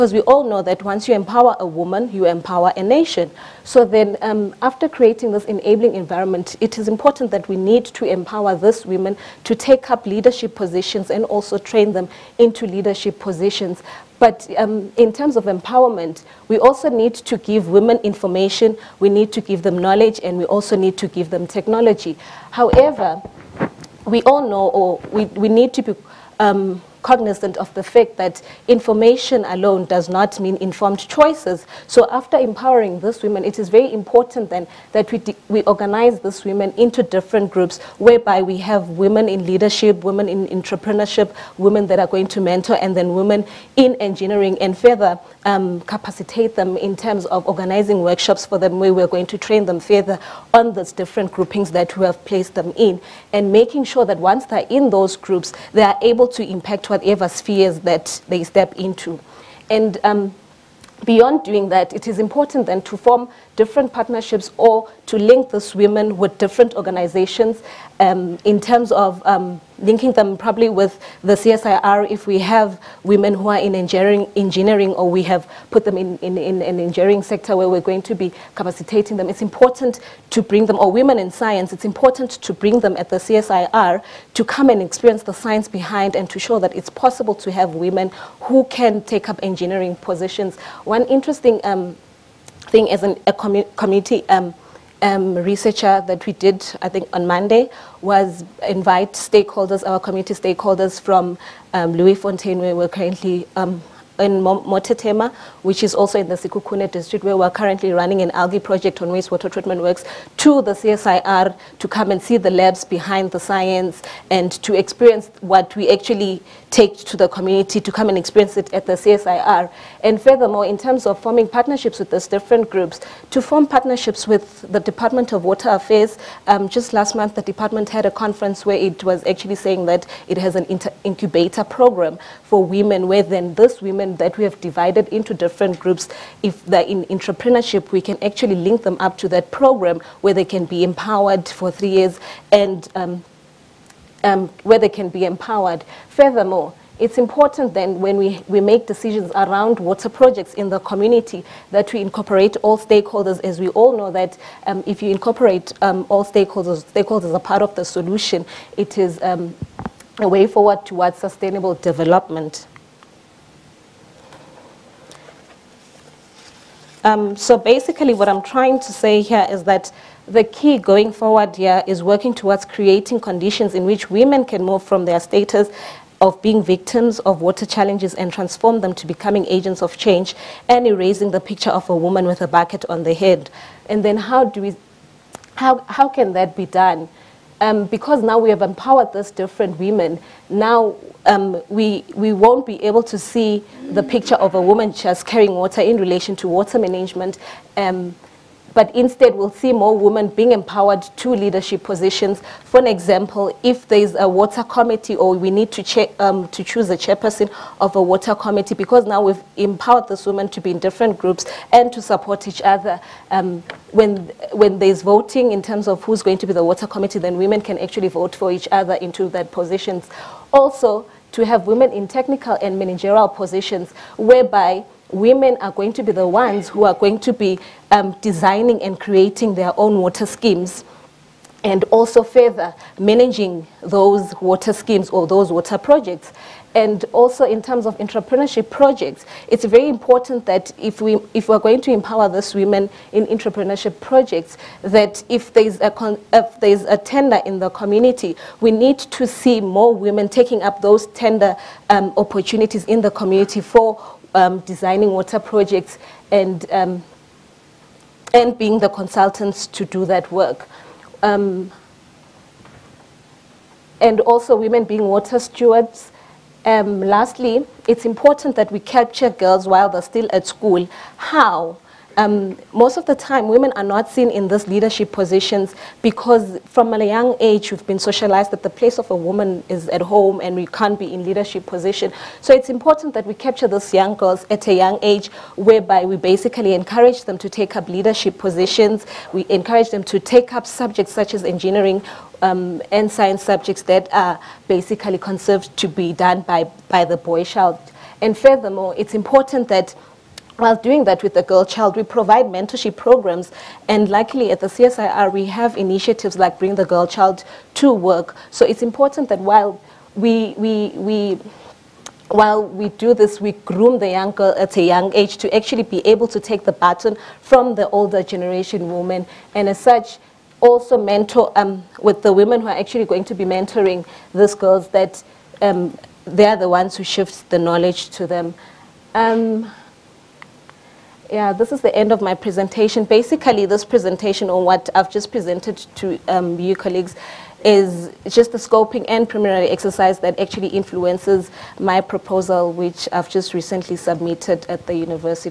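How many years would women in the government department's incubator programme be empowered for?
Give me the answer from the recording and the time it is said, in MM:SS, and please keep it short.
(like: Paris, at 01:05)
3, at 02:21.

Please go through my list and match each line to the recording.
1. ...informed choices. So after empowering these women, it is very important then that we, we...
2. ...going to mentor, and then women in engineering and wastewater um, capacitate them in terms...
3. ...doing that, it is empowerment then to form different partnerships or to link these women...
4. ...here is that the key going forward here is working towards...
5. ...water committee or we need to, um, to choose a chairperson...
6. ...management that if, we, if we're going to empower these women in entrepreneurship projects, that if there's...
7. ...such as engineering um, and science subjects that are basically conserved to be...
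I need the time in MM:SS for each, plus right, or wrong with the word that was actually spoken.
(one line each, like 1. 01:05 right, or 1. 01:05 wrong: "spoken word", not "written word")
1. 00:30 right
2. 00:42 wrong: "further", not "wastewater"
3. 01:01 wrong: "important", not "empowerment"
4. 02:49 right
5. 03:24 right
6. 03:59 wrong: "important", not "management"
7. 04:51 right.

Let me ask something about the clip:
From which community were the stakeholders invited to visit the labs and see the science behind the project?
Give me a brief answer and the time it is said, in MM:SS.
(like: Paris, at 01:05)
Leeufontein, at 01:41.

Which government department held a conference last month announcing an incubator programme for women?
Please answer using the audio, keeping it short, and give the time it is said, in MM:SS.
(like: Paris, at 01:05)
Department of Water Affairs, at 02:04.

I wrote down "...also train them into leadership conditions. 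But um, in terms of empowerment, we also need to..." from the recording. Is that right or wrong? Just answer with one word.
wrong.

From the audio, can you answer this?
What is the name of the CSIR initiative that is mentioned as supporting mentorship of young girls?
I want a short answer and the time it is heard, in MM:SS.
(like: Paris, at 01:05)
Bring the Girl Child to Work, at 05:06.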